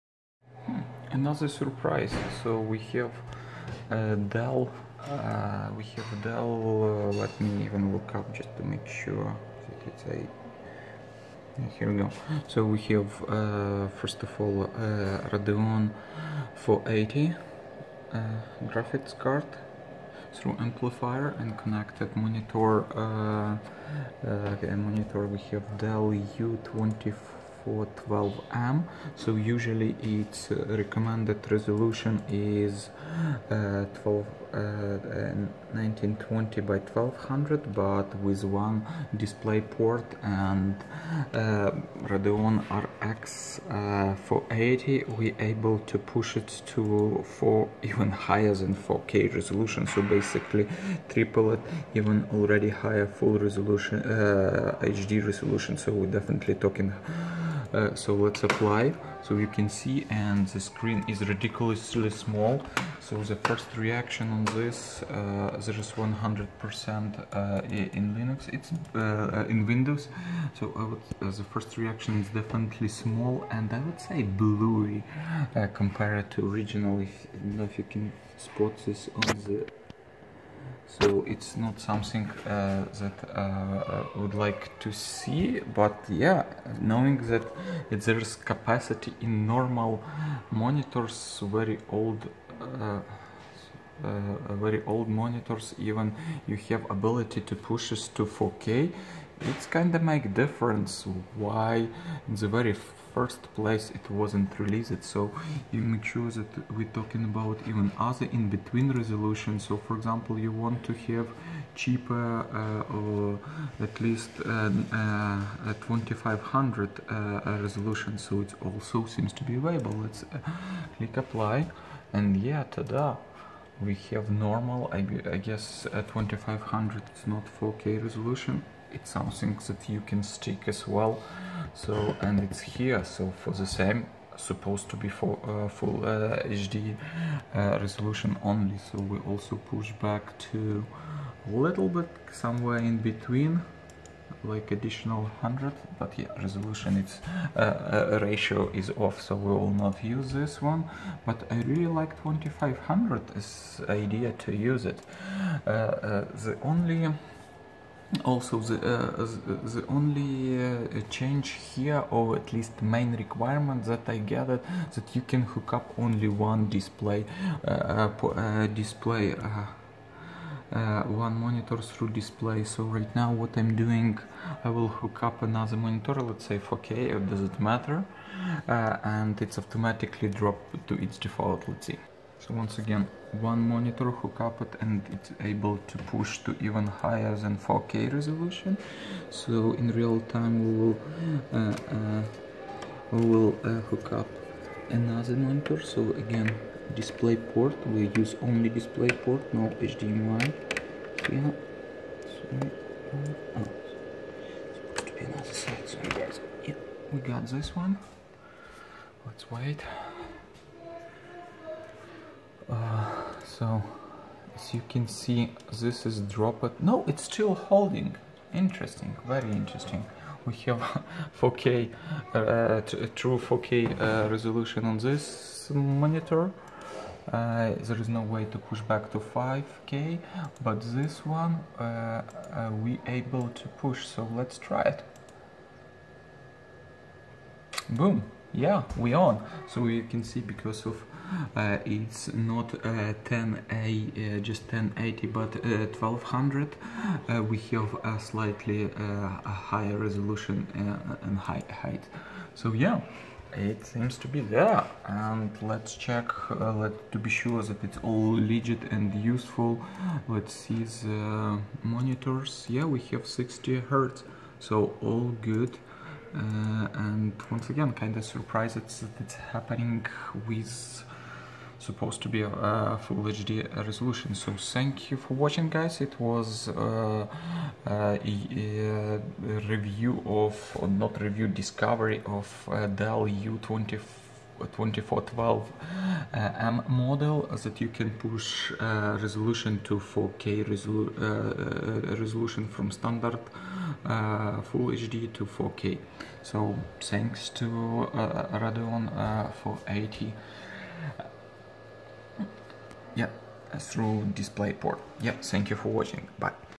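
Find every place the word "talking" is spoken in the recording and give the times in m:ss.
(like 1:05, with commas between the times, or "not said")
0:56, 1:46.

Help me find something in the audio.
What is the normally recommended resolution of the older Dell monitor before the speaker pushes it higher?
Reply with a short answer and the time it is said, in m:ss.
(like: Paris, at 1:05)
1920 by 1200, at 0:35.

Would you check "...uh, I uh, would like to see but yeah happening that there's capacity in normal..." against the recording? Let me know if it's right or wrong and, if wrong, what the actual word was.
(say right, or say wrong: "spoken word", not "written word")
wrong: "knowing", not "happening".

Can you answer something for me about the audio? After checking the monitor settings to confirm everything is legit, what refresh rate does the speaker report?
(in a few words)
60 hertz.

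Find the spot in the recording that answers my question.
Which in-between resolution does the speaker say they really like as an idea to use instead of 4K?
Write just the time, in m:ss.
2:31.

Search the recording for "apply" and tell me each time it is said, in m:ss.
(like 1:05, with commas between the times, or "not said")
0:58, 2:01.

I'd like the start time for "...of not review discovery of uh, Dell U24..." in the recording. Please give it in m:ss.
4:40.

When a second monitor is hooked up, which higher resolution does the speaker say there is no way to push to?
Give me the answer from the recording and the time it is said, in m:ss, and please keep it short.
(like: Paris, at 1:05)
5K, at 3:49.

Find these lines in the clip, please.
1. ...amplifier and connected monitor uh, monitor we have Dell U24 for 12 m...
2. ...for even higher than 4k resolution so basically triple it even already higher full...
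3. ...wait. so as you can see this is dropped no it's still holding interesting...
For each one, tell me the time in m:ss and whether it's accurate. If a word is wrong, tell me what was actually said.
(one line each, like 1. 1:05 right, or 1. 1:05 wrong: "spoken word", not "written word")
1. 0:20 right
2. 0:47 right
3. 3:29 right.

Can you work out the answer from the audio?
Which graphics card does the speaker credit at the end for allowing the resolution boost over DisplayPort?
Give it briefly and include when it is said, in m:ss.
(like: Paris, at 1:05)
Radeon 480, at 4:58.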